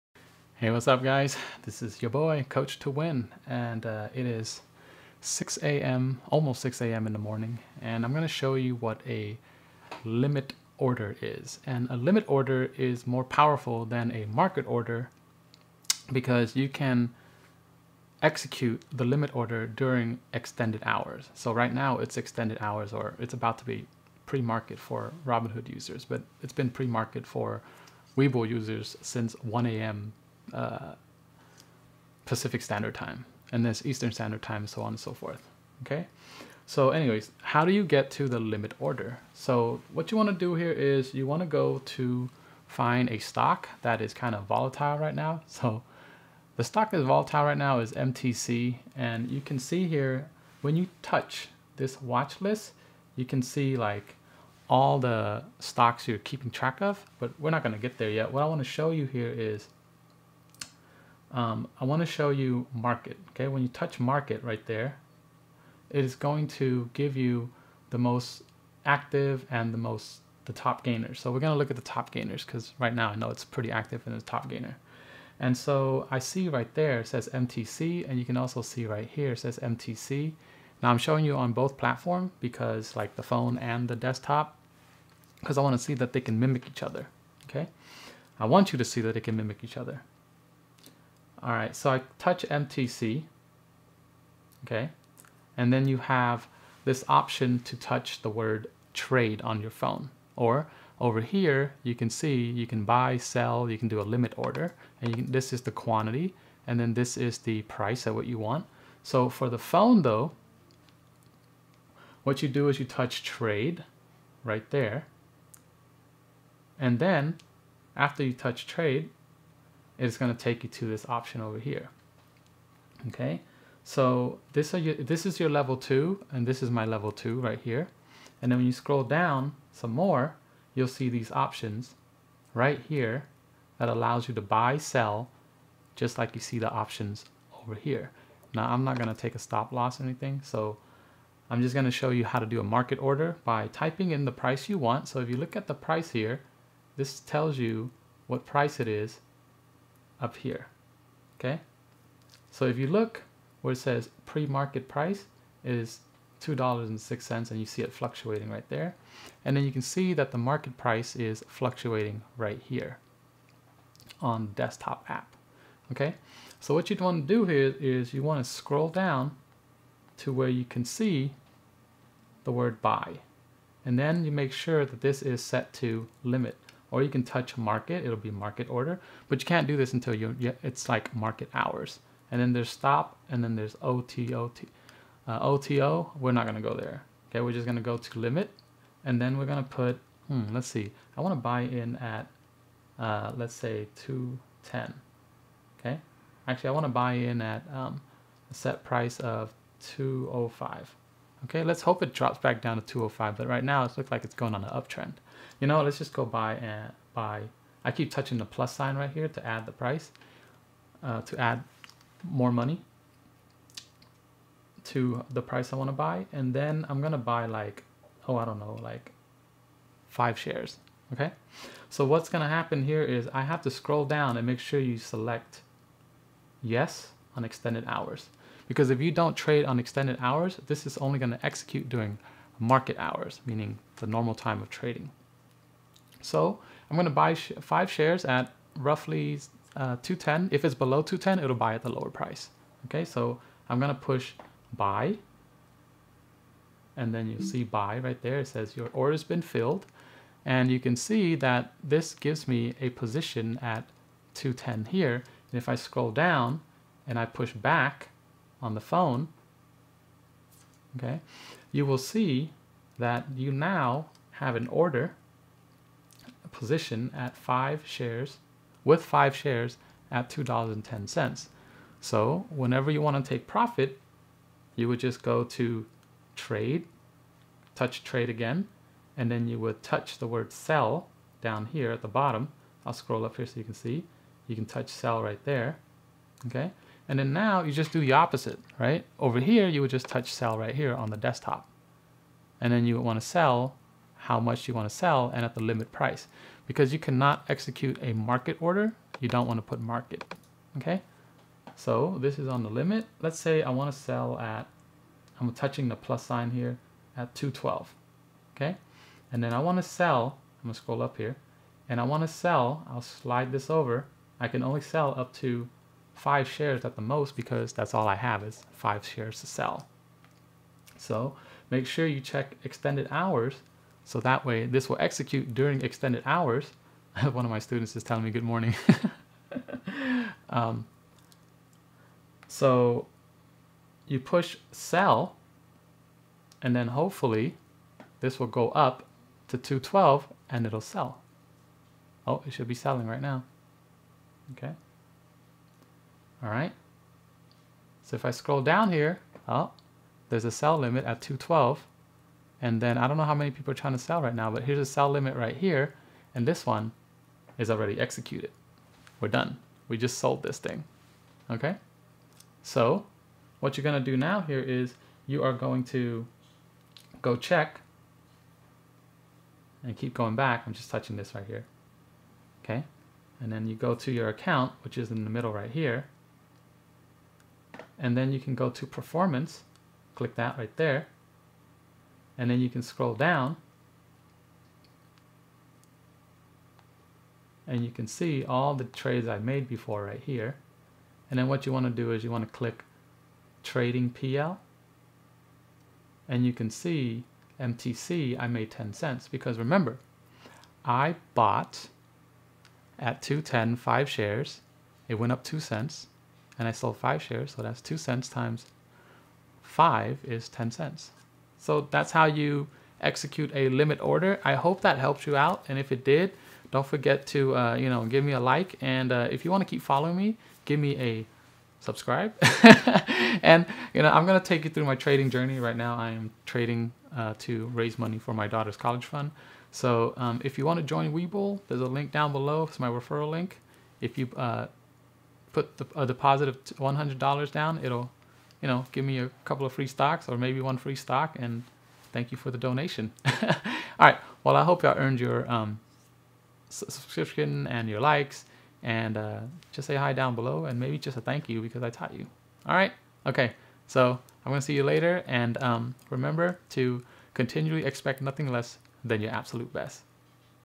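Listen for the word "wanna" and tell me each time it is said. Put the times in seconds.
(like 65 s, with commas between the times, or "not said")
191 s, 196 s.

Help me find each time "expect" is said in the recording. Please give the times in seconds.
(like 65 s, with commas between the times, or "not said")
457 s.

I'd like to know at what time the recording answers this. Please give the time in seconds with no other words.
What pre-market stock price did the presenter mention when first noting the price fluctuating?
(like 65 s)
156 s.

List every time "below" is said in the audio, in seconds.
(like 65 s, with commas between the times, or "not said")
240 s, 432 s, 450 s.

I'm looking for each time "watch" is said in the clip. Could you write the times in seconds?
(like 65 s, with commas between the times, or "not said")
52 s.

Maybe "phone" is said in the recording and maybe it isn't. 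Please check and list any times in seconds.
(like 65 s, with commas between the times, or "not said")
83 s, 99 s, 109 s, 258 s.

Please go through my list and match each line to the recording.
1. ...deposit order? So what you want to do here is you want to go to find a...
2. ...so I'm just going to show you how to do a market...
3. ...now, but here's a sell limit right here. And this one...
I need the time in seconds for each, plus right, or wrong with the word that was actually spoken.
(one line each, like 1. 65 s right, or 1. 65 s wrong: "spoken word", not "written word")
1. 38 s wrong: "limit", not "deposit"
2. 140 s right
3. 354 s right.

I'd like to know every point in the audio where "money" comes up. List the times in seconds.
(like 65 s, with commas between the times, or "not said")
212 s, 427 s.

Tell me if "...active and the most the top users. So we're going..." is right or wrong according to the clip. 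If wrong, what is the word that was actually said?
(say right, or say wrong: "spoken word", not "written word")
wrong: "gainers", not "users".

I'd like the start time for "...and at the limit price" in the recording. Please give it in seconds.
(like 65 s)
295 s.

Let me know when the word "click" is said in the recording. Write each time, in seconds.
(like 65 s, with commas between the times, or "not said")
380 s, 392 s.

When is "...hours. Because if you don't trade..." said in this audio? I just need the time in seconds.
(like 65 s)
227 s.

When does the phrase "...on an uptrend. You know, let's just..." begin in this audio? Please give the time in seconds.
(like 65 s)
204 s.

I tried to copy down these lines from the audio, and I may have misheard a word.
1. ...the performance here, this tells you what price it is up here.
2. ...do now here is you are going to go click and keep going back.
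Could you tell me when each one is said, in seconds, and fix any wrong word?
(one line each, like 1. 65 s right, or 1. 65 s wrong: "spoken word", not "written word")
1. 145 s wrong: "price", not "performance"
2. 363 s wrong: "check", not "click".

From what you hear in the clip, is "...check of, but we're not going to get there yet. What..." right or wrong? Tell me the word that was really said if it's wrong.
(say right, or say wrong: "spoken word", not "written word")
wrong: "track", not "check".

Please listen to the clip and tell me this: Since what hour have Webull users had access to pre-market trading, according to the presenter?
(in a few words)
1 a.m.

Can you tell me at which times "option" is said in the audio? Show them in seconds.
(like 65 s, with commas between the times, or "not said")
97 s, 121 s, 131 s, 136 s.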